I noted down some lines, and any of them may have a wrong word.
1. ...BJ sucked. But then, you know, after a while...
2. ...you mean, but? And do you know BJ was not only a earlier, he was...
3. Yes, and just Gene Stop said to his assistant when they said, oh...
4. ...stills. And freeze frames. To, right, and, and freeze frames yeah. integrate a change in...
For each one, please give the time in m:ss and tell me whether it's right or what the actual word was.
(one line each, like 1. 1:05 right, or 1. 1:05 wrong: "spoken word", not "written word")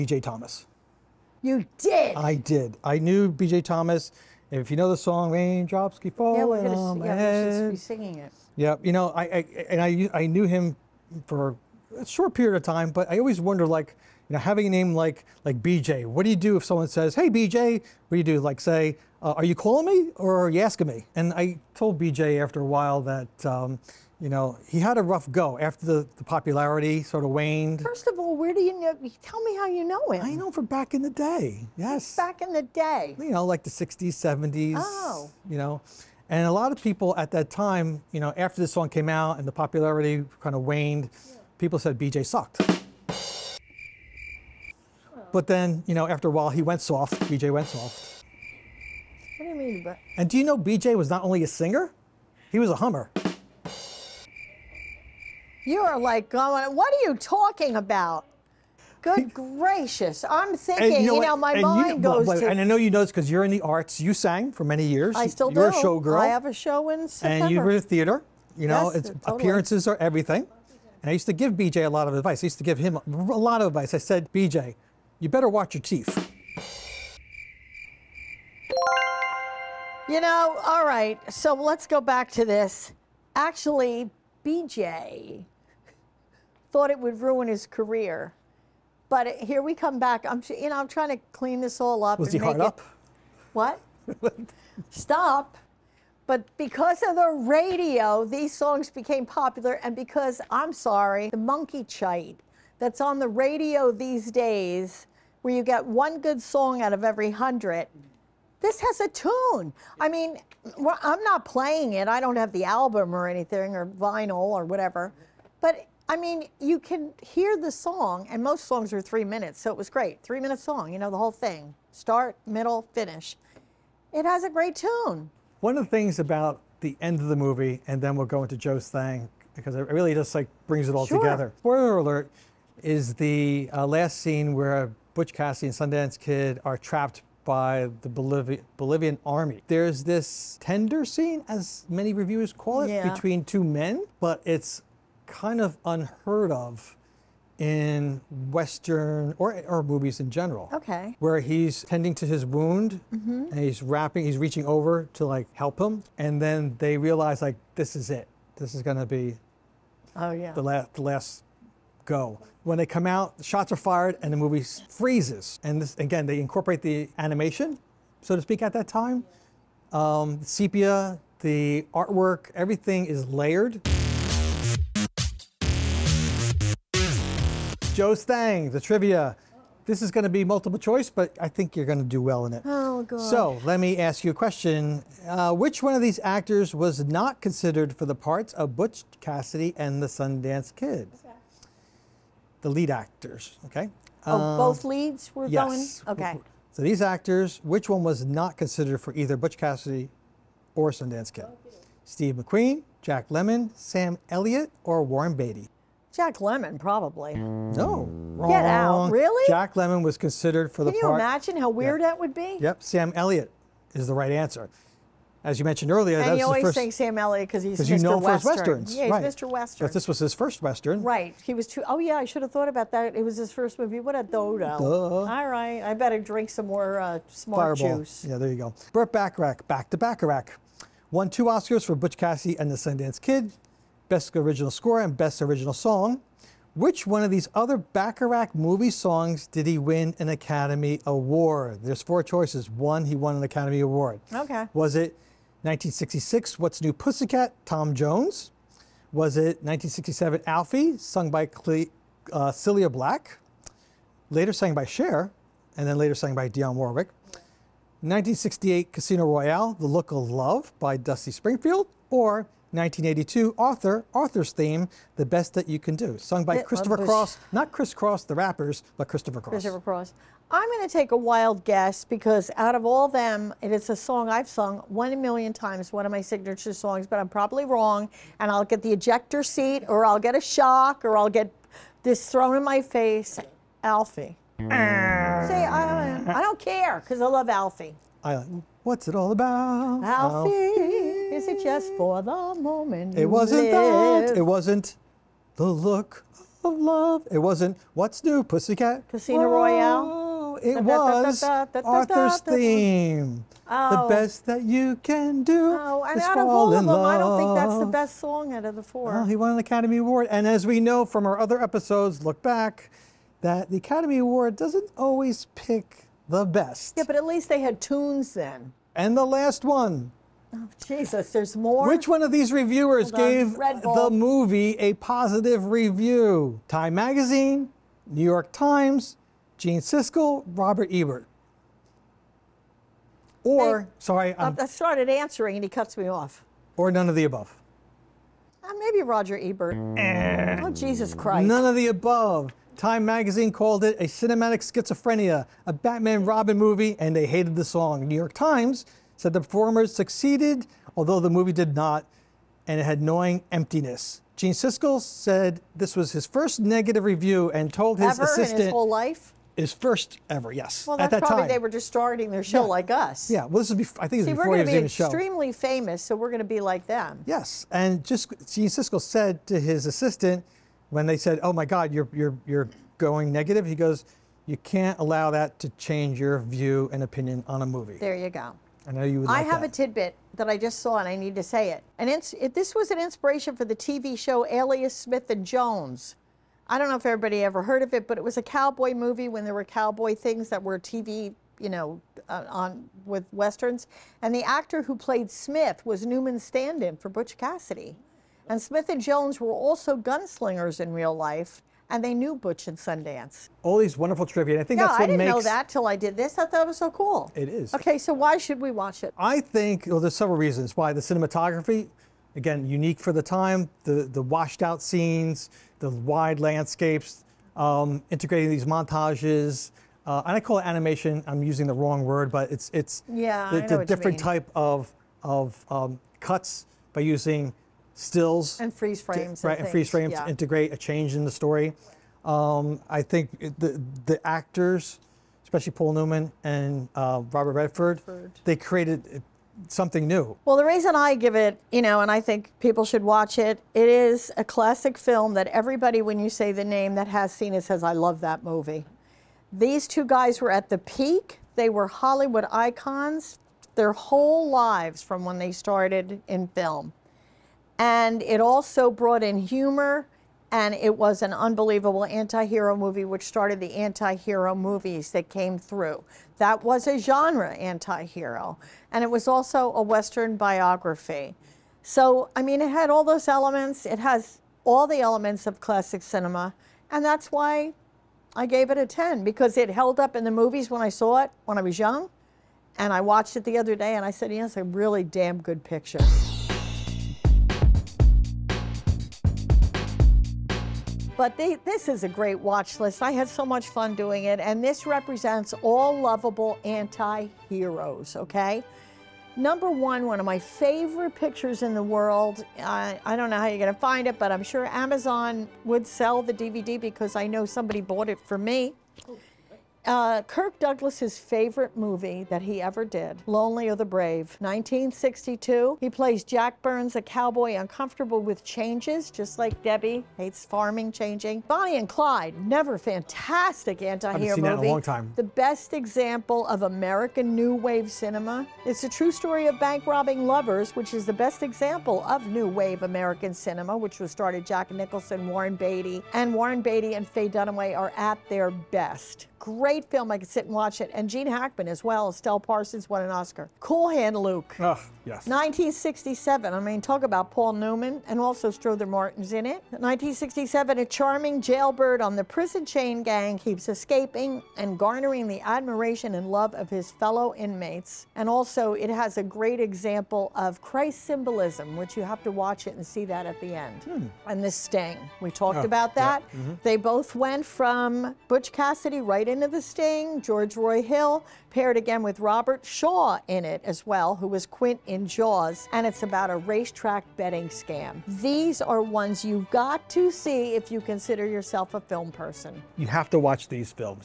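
1. 0:41 right
2. 0:49 wrong: "singer", not "earlier"
3. 6:07 wrong: "Siskel", not "Stop"
4. 7:07 right.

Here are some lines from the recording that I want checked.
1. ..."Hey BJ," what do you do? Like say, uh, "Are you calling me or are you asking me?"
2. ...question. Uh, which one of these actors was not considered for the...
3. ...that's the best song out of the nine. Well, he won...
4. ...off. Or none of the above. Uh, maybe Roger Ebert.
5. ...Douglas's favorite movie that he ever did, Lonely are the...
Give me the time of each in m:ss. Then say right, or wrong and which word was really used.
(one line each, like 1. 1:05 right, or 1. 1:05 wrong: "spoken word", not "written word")
1. 0:17 right
2. 3:04 right
3. 5:07 wrong: "four", not "nine"
4. 5:36 right
5. 8:30 right.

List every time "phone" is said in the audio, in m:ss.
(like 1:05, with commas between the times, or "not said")
not said.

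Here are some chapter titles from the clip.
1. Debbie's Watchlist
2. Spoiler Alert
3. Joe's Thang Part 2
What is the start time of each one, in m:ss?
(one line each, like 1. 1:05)
1. 8:04
2. 2:11
3. 2:52.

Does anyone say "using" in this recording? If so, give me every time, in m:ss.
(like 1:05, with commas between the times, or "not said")
7:01, 7:06.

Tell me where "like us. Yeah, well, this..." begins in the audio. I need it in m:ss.
6:02.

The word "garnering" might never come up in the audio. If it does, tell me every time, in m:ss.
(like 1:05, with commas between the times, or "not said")
9:14.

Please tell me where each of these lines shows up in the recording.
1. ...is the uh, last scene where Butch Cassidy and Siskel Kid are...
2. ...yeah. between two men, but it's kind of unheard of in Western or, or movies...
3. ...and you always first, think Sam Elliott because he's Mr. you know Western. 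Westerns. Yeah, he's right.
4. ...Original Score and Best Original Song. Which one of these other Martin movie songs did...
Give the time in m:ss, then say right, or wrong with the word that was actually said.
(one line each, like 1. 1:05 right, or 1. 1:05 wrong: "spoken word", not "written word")
1. 2:12 wrong: "Sundance", not "Siskel"
2. 2:22 right
3. 3:36 right
4. 3:54 wrong: "Bacharach", not "Martin".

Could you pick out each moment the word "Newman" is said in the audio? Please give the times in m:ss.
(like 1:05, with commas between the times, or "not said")
6:36, 7:15, 9:07.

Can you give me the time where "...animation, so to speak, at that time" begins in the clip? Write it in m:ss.
2:47.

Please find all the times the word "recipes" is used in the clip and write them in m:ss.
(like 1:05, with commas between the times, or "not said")
not said.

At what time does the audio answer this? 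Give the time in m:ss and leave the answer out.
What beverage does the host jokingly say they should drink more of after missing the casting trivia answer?
3:47.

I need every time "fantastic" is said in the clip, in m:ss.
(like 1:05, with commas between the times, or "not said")
8:42.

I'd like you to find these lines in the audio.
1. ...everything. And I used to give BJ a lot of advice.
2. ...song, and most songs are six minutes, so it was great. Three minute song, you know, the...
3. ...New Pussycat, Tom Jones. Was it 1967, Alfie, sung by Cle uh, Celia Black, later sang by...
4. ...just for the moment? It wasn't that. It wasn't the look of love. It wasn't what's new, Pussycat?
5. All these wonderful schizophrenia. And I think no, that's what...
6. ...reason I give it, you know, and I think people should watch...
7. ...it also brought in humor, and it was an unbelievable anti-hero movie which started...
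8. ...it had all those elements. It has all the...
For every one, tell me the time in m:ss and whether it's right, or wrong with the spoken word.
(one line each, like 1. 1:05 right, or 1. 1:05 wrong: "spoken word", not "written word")
1. 1:09 right
2. 1:57 wrong: "three", not "six"
3. 4:06 right
4. 4:51 right
5. 6:43 wrong: "trivia", not "schizophrenia"
6. 7:20 right
7. 7:38 right
8. 7:52 right.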